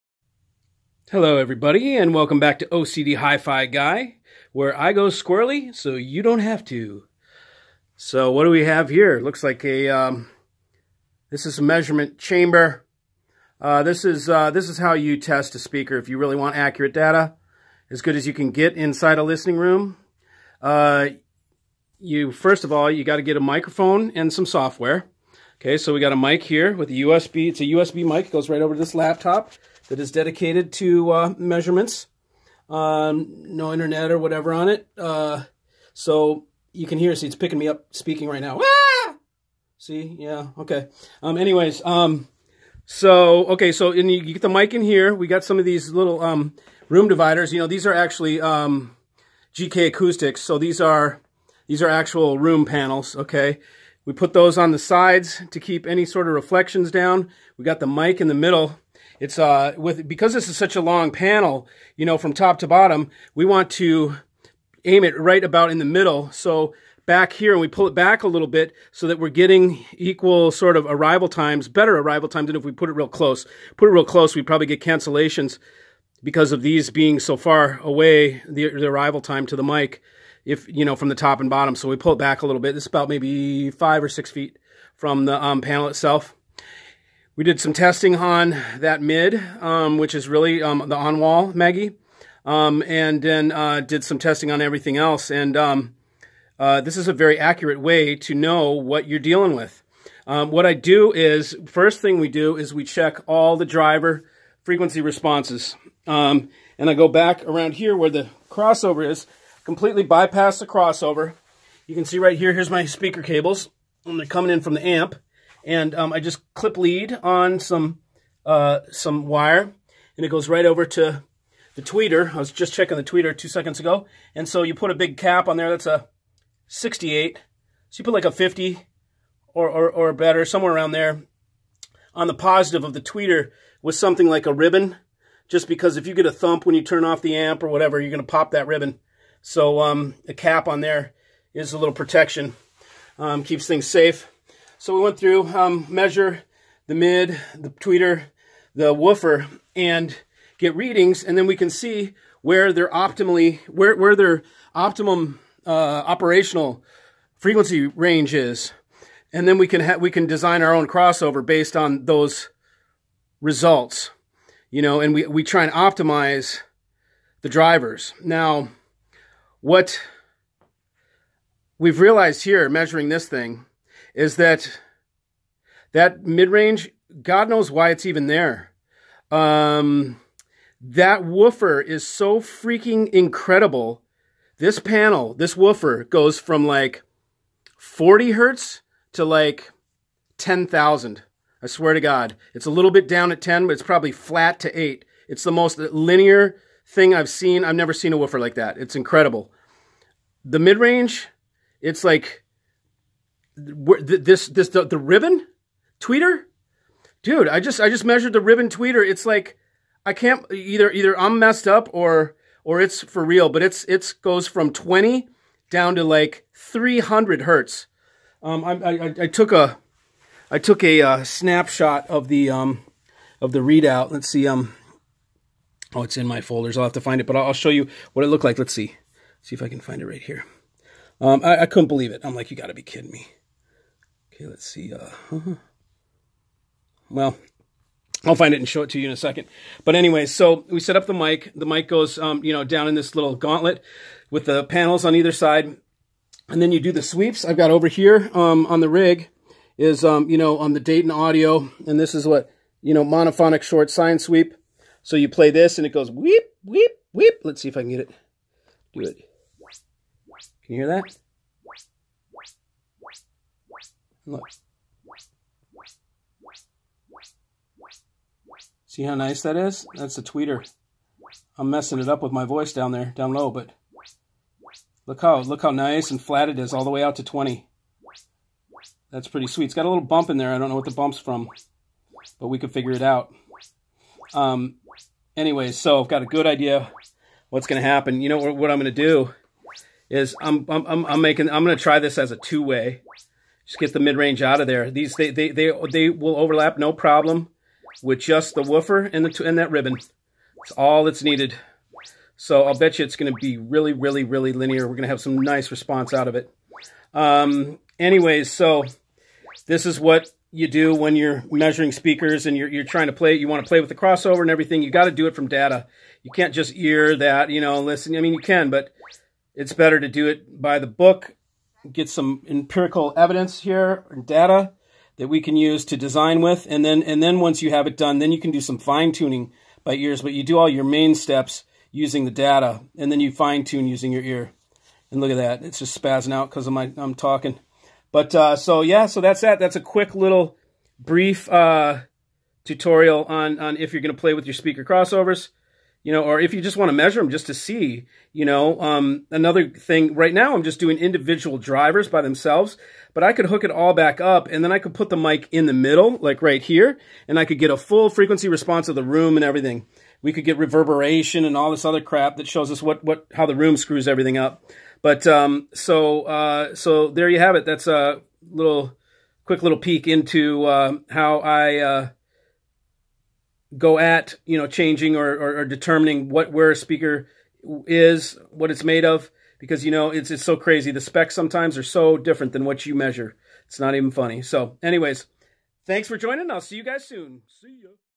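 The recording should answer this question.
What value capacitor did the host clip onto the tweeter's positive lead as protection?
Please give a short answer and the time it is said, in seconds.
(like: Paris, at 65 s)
68, at 126 s.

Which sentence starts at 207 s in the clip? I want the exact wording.
I just I just measured the ribbon tweeter.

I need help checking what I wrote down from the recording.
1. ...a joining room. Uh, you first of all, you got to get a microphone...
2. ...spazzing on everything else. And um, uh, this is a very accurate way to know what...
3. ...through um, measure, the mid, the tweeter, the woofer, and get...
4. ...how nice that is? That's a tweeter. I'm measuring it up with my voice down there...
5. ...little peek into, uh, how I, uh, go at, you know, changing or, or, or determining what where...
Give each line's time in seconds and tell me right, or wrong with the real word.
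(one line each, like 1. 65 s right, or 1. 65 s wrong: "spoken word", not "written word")
1. 19 s wrong: "listening", not "joining"
2. 94 s wrong: "testing", not "spazzing"
3. 145 s right
4. 269 s wrong: "messing", not "measuring"
5. 369 s right.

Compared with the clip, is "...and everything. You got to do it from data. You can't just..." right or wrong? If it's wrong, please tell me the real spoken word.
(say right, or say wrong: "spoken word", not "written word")
right.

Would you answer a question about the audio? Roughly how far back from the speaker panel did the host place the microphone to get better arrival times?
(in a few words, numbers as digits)
5 or 6 feet.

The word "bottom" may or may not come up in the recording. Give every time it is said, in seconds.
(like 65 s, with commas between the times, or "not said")
62 s, 81 s.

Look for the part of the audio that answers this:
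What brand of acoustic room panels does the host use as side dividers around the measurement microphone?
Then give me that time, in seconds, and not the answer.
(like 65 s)
49 s.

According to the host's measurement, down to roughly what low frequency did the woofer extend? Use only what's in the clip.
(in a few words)
40 hertz.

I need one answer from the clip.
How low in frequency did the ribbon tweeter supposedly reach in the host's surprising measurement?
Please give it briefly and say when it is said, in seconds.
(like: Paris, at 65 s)
300 hertz, at 216 s.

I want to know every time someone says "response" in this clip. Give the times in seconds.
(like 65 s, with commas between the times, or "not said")
105 s, 305 s, 358 s.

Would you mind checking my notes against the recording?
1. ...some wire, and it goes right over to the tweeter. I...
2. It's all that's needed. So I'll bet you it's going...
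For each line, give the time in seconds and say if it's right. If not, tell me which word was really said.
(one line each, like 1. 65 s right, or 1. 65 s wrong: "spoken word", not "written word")
1. 118 s right
2. 299 s right.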